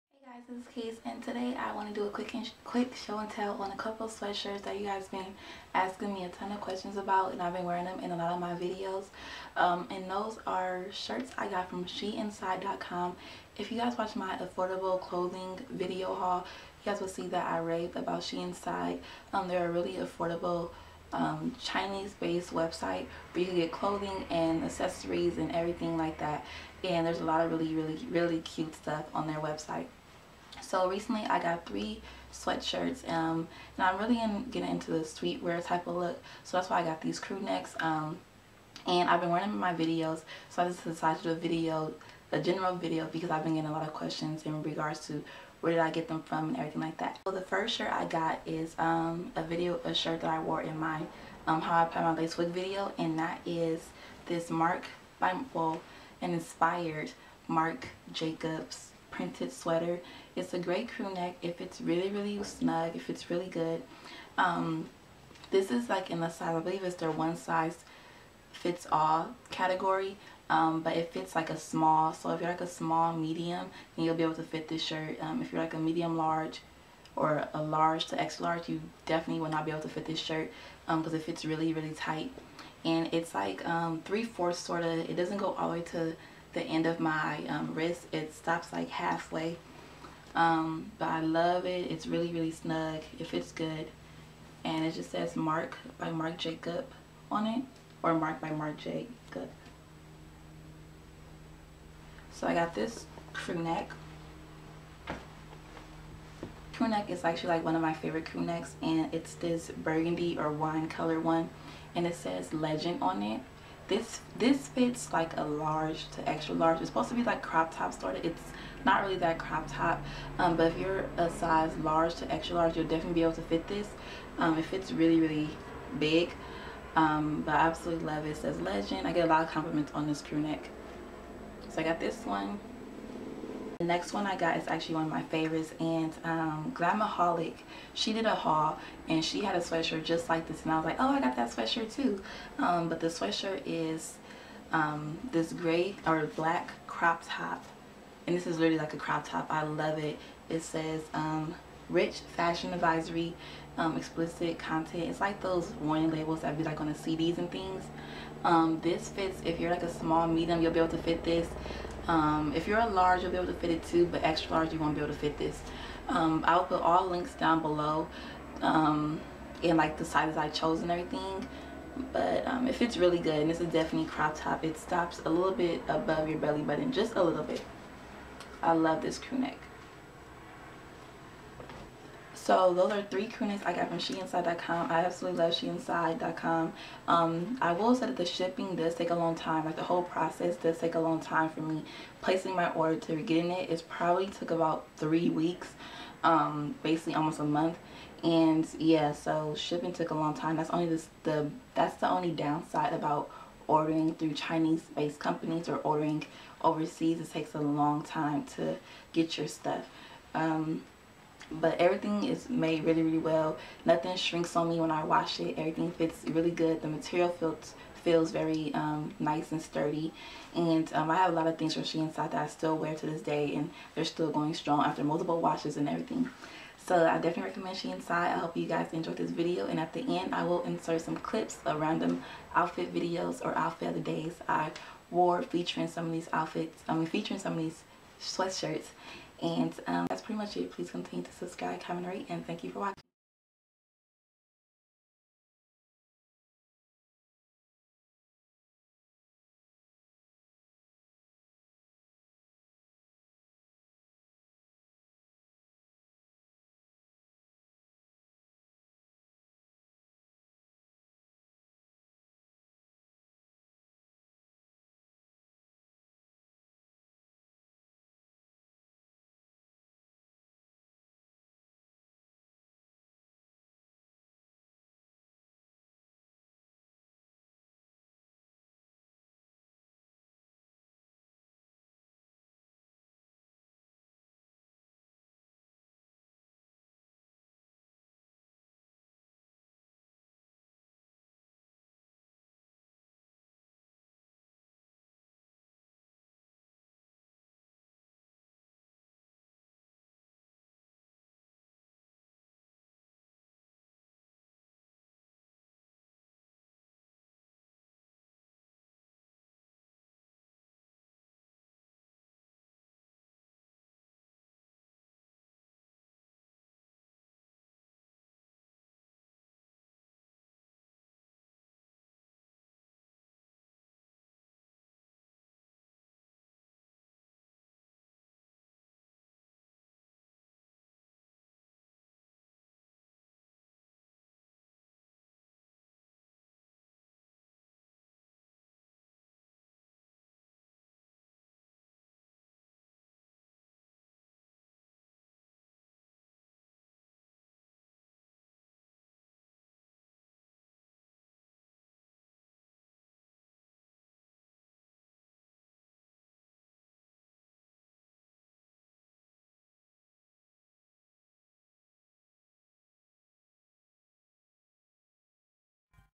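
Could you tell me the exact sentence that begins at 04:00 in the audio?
Please continue to subscribe, comment, rate, and thank you for watching.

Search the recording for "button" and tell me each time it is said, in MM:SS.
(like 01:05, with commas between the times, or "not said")
02:56.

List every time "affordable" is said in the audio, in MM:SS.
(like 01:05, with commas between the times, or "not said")
00:14, 00:19.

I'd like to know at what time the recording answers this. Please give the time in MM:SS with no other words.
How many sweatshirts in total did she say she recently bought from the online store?
00:31.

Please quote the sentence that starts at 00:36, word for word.
So that's why I got these crew necks um, and I've been wearing them in my videos.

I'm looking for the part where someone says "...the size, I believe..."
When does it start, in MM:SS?
01:06.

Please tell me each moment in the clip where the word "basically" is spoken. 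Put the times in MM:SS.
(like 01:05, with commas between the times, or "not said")
03:16.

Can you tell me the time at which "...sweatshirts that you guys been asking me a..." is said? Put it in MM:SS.
00:04.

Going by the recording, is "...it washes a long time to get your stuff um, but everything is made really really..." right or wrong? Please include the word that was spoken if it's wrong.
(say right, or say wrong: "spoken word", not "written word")
wrong: "takes", not "washes".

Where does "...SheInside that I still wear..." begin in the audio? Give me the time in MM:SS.
03:41.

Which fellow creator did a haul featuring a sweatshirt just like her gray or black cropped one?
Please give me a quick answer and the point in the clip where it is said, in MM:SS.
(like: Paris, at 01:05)
Glamaholic, at 02:16.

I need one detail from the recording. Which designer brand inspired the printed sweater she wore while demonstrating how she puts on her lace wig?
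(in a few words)
Marc Jacobs.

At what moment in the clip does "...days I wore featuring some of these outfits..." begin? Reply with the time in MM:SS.
03:53.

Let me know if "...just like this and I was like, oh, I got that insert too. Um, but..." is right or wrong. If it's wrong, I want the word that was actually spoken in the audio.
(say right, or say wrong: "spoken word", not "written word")
wrong: "sweatshirt", not "insert".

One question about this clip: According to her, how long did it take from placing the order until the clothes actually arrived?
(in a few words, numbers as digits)
3 weeks.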